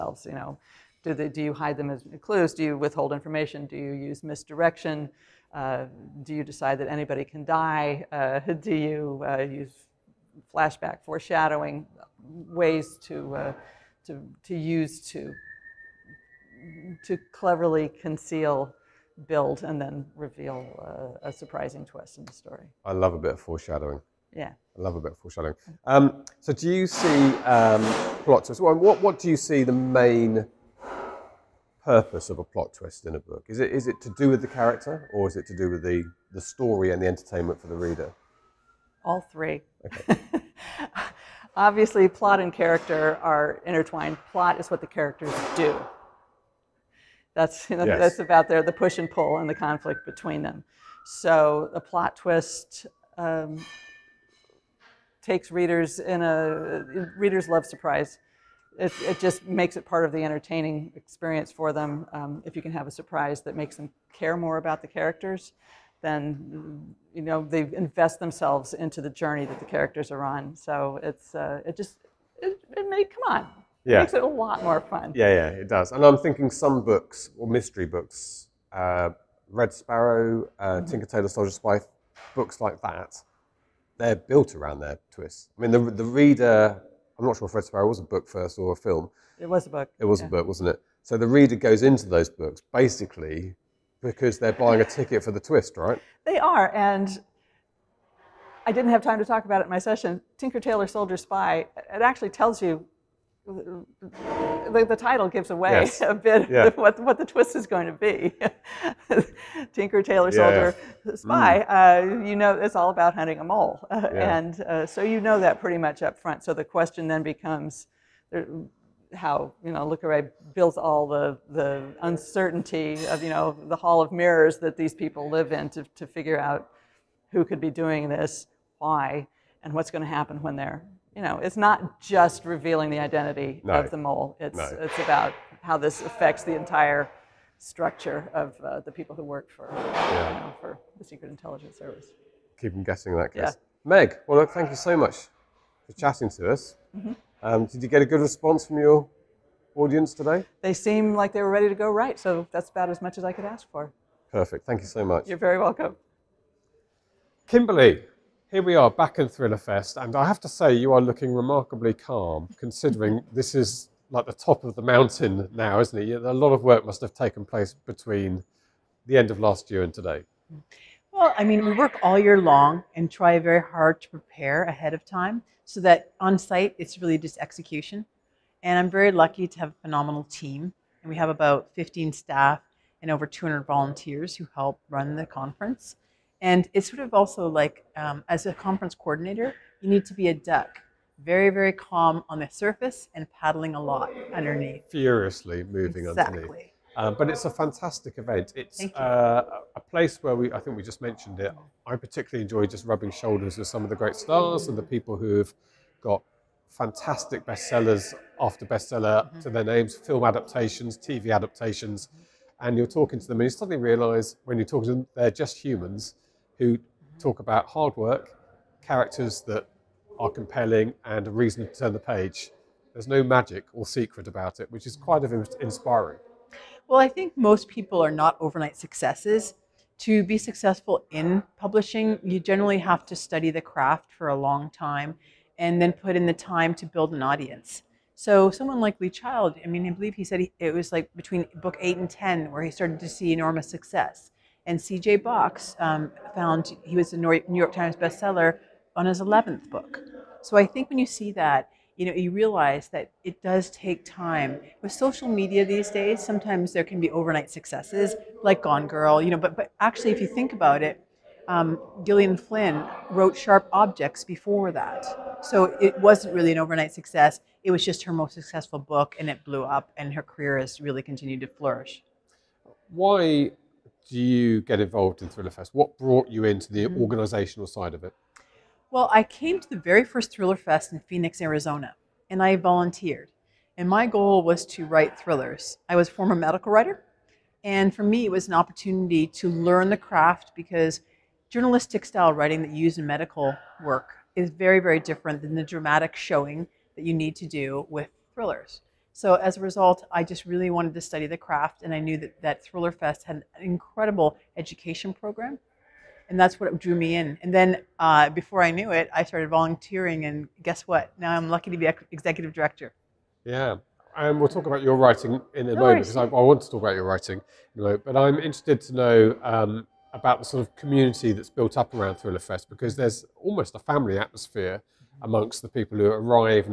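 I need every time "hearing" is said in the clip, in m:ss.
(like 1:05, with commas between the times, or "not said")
not said.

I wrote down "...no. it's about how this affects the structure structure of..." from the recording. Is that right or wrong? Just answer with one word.
wrong.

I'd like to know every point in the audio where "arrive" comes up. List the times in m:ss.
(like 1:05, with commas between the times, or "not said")
5:26.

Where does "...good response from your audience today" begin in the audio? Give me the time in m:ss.
2:28.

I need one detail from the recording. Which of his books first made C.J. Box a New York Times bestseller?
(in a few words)
11th book.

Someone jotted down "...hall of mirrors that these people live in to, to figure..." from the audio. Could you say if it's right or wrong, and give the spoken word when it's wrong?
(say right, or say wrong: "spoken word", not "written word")
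right.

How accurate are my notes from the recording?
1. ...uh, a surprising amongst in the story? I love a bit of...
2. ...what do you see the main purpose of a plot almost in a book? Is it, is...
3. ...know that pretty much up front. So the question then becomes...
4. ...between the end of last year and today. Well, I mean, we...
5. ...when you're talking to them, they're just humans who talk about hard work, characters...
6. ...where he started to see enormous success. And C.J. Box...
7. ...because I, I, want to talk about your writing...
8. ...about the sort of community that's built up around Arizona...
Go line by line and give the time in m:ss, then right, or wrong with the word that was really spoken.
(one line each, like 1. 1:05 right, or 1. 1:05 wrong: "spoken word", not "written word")
1. 0:20 wrong: "twist", not "amongst"
2. 0:29 wrong: "twist", not "almost"
3. 1:55 right
4. 2:47 right
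5. 3:34 right
6. 4:02 right
7. 5:16 right
8. 5:20 wrong: "Thriller", not "Arizona".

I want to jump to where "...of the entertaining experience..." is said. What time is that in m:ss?
1:00.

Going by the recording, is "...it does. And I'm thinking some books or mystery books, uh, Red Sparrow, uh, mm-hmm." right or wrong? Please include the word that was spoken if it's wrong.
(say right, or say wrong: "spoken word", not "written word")
right.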